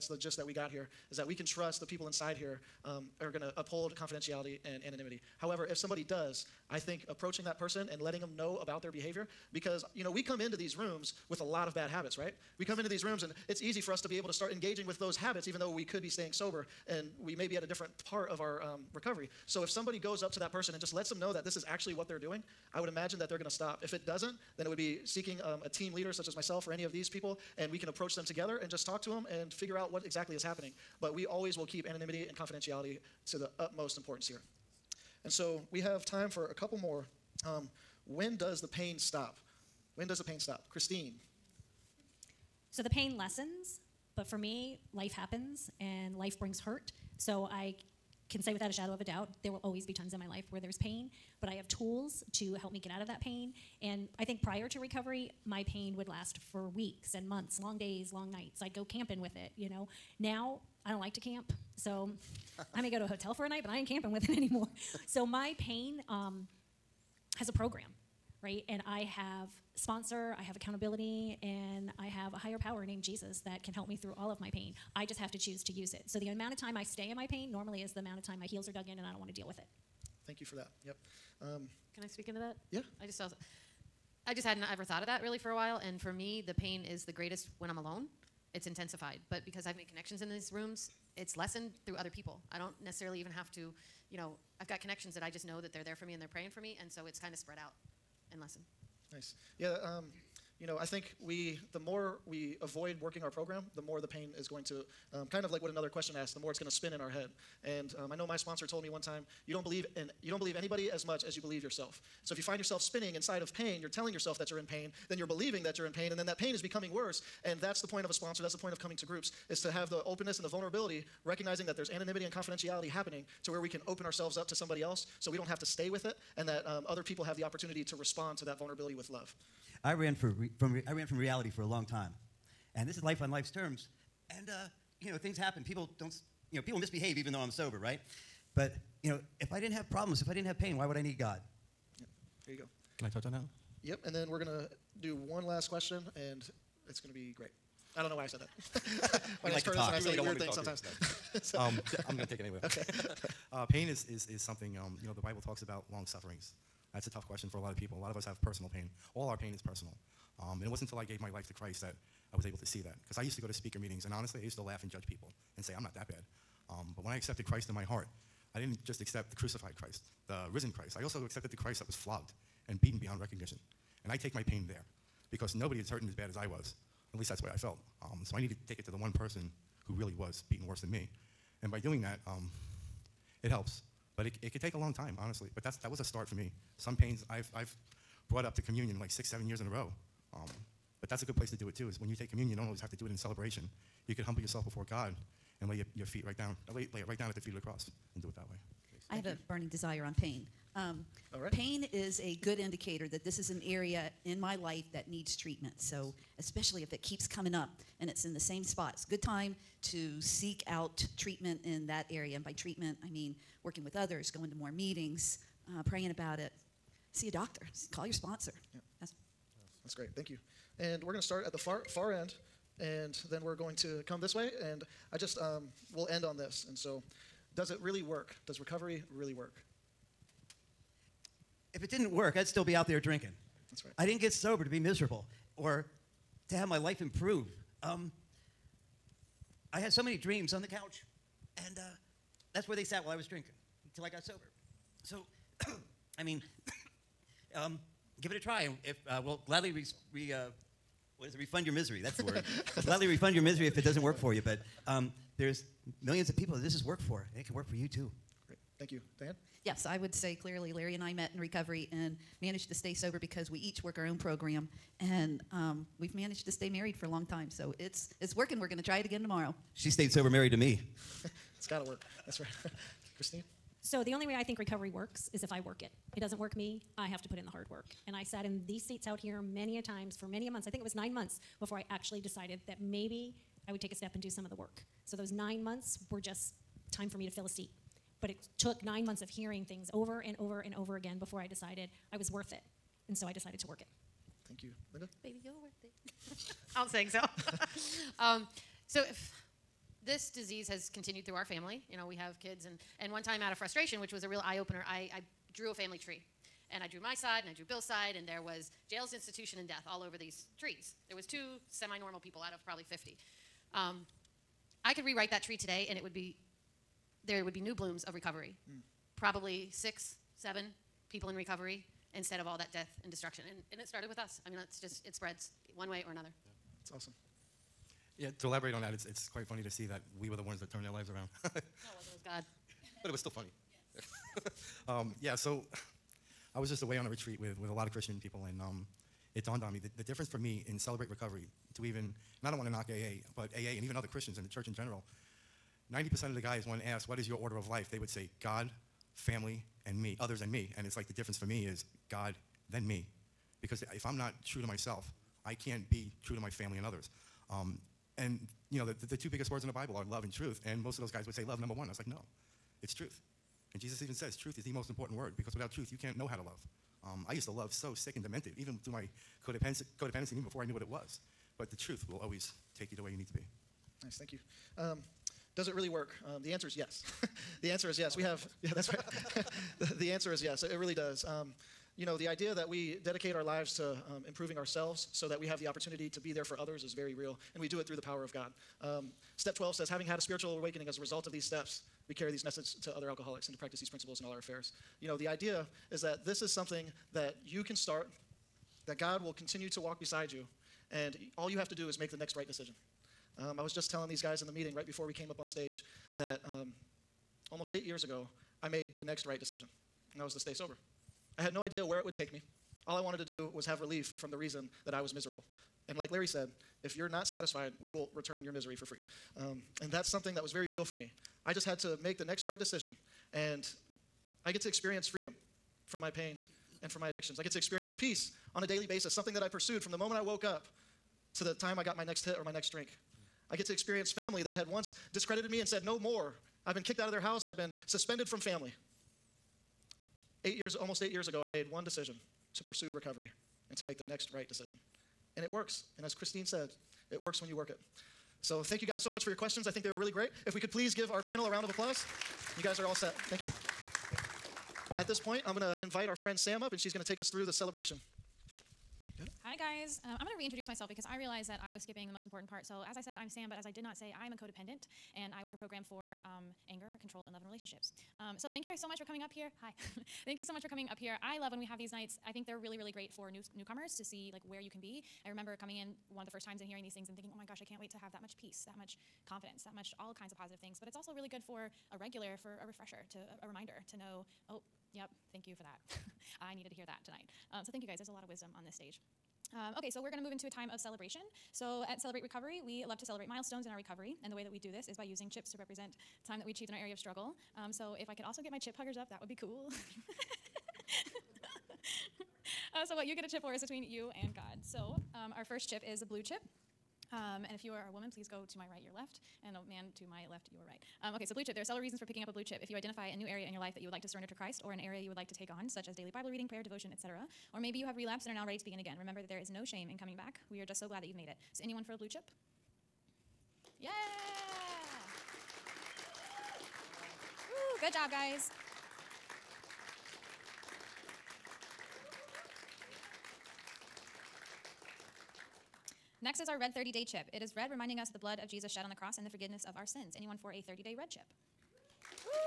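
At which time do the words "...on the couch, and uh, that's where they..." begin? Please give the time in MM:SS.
04:00.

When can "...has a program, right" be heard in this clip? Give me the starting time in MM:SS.
01:07.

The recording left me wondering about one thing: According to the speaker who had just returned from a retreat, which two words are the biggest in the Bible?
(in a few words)
love and truth.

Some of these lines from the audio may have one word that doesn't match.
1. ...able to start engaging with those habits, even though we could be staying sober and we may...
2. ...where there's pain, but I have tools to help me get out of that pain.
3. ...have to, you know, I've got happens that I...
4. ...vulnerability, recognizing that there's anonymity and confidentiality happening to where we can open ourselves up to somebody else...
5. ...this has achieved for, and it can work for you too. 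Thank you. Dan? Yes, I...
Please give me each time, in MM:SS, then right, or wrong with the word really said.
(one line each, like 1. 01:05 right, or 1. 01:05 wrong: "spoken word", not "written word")
1. 00:14 right
2. 00:50 right
3. 01:33 wrong: "connections", not "happens"
4. 02:00 right
5. 04:16 wrong: "worked", not "achieved".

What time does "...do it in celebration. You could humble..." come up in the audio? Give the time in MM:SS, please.
03:12.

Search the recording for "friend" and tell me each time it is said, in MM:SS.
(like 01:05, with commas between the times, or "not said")
07:36.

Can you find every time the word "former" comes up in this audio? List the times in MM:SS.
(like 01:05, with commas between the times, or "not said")
not said.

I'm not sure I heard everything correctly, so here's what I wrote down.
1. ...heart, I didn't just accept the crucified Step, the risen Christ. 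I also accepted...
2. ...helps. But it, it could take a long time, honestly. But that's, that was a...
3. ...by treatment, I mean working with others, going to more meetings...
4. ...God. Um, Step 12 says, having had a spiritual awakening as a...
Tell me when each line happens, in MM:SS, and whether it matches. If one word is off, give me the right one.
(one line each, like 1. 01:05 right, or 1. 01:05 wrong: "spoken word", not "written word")
1. 02:47 wrong: "Christ", not "Step"
2. 03:03 right
3. 03:32 right
4. 06:28 right.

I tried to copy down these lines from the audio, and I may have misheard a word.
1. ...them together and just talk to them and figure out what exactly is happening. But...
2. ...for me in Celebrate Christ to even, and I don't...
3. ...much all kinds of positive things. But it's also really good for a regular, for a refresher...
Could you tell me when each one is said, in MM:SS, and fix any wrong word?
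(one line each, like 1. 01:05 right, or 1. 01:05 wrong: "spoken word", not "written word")
1. 00:28 right
2. 05:40 wrong: "Recovery", not "Christ"
3. 07:59 right.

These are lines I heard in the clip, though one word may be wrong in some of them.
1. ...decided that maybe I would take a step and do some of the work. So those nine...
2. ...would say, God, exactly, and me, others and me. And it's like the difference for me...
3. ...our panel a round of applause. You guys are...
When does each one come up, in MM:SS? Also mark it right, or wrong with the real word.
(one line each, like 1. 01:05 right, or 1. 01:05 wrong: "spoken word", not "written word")
1. 04:42 right
2. 05:47 wrong: "family", not "exactly"
3. 07:31 right.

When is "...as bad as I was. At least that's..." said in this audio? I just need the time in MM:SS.
02:56.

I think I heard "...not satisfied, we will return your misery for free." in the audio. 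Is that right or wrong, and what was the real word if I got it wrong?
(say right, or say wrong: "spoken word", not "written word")
right.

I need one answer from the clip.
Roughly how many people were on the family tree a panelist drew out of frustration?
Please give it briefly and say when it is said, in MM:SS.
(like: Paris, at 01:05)
50, at 05:12.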